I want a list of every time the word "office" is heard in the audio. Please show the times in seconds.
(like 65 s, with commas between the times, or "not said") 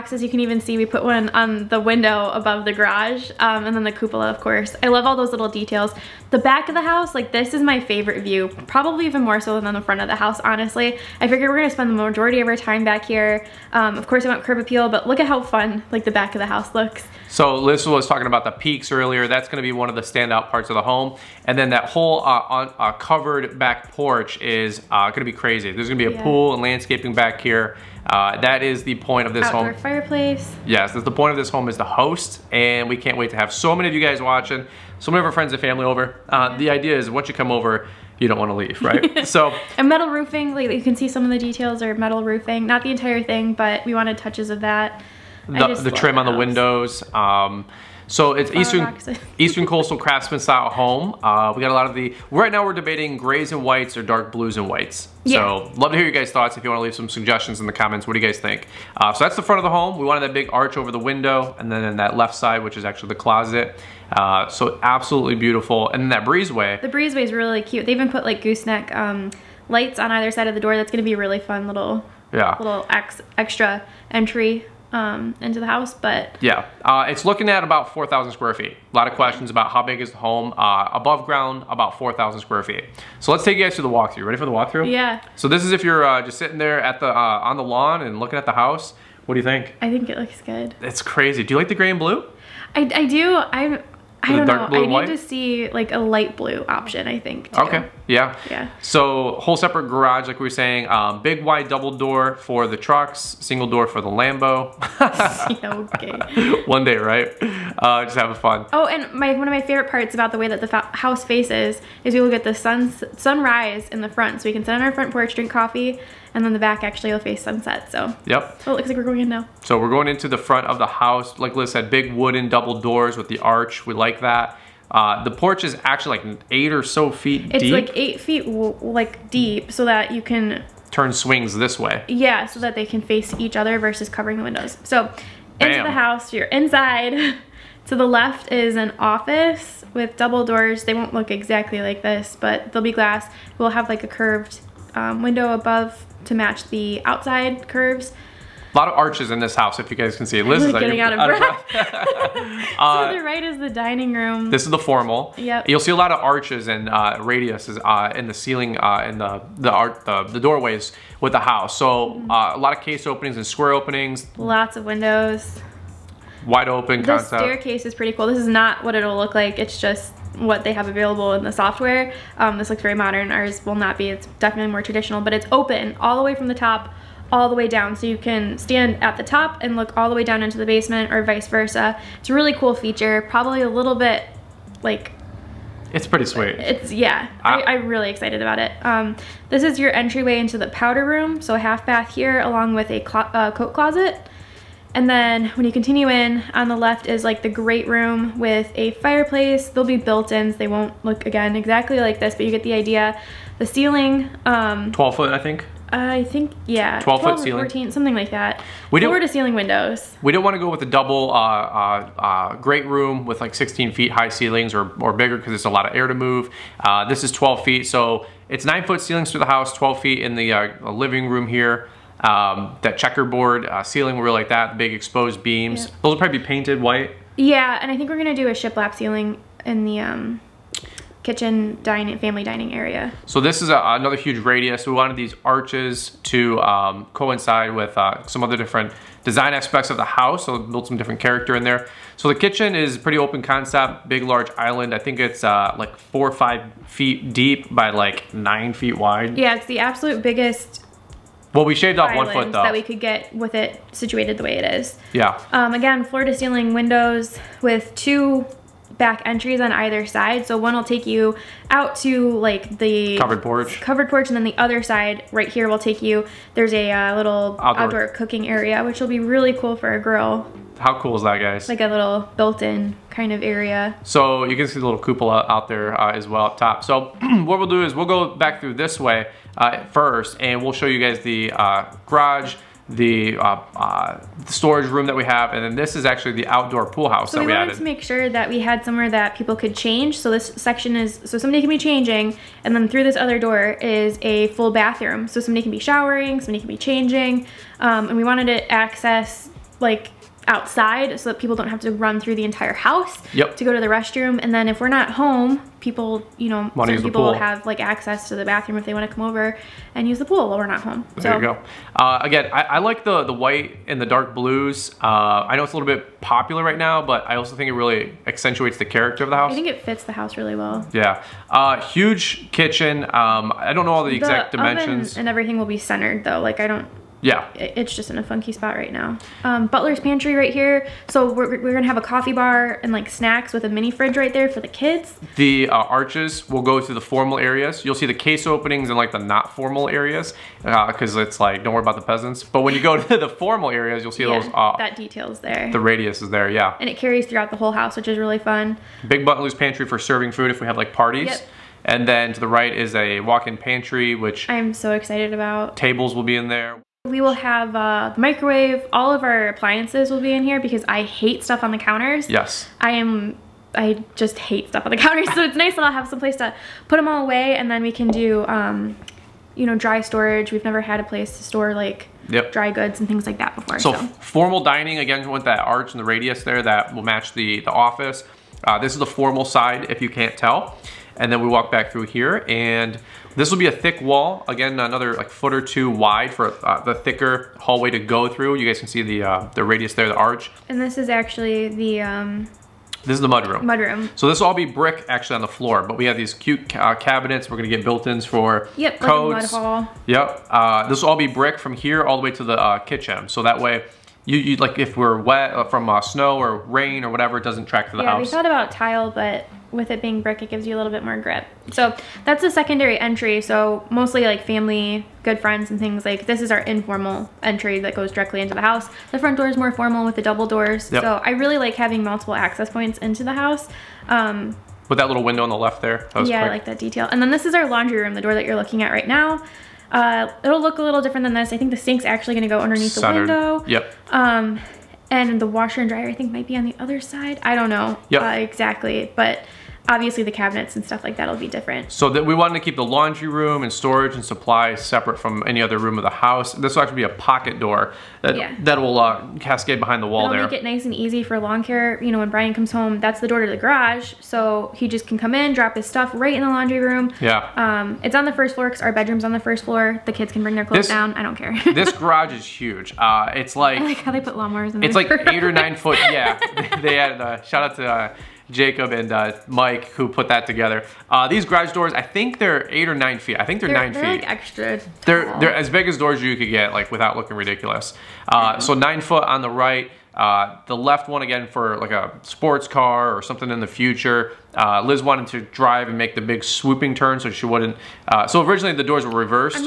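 138 s, 377 s.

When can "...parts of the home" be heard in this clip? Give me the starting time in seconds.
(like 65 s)
20 s.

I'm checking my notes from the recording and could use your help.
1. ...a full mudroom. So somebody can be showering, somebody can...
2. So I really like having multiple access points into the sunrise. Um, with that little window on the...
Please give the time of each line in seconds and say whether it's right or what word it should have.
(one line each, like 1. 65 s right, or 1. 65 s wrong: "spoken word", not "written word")
1. 294 s wrong: "bathroom", not "mudroom"
2. 421 s wrong: "house", not "sunrise".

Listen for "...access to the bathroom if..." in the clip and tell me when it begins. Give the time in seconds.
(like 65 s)
307 s.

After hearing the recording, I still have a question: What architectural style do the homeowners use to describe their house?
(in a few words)
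Eastern Coastal Craftsman.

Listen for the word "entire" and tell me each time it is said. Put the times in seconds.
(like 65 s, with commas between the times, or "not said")
42 s, 302 s.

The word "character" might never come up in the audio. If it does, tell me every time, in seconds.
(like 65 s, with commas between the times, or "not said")
241 s, 318 s.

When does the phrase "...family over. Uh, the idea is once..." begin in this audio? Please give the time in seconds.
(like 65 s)
35 s.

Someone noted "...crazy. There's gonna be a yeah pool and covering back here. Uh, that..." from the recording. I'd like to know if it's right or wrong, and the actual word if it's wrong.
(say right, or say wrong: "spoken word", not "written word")
wrong: "landscaping", not "covering".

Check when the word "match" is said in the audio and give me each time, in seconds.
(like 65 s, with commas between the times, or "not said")
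146 s, 377 s.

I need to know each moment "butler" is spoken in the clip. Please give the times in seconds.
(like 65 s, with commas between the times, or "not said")
329 s, 349 s.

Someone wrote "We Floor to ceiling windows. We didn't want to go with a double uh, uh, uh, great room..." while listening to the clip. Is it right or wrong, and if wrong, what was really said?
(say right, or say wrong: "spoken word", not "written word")
right.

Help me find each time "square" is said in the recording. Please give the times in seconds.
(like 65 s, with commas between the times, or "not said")
78 s, 82 s, 163 s.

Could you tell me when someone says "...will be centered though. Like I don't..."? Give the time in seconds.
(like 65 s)
325 s.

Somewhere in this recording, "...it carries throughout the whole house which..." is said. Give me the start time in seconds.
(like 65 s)
346 s.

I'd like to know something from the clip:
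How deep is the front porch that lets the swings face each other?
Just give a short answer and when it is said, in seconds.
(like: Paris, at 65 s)
8 feet, at 127 s.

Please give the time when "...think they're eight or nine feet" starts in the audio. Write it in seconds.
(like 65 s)
472 s.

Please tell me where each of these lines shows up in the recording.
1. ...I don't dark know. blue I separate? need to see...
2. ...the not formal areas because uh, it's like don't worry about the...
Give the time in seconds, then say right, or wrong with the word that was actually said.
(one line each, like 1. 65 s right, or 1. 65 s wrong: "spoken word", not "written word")
1. 94 s wrong: "white", not "separate"
2. 339 s right.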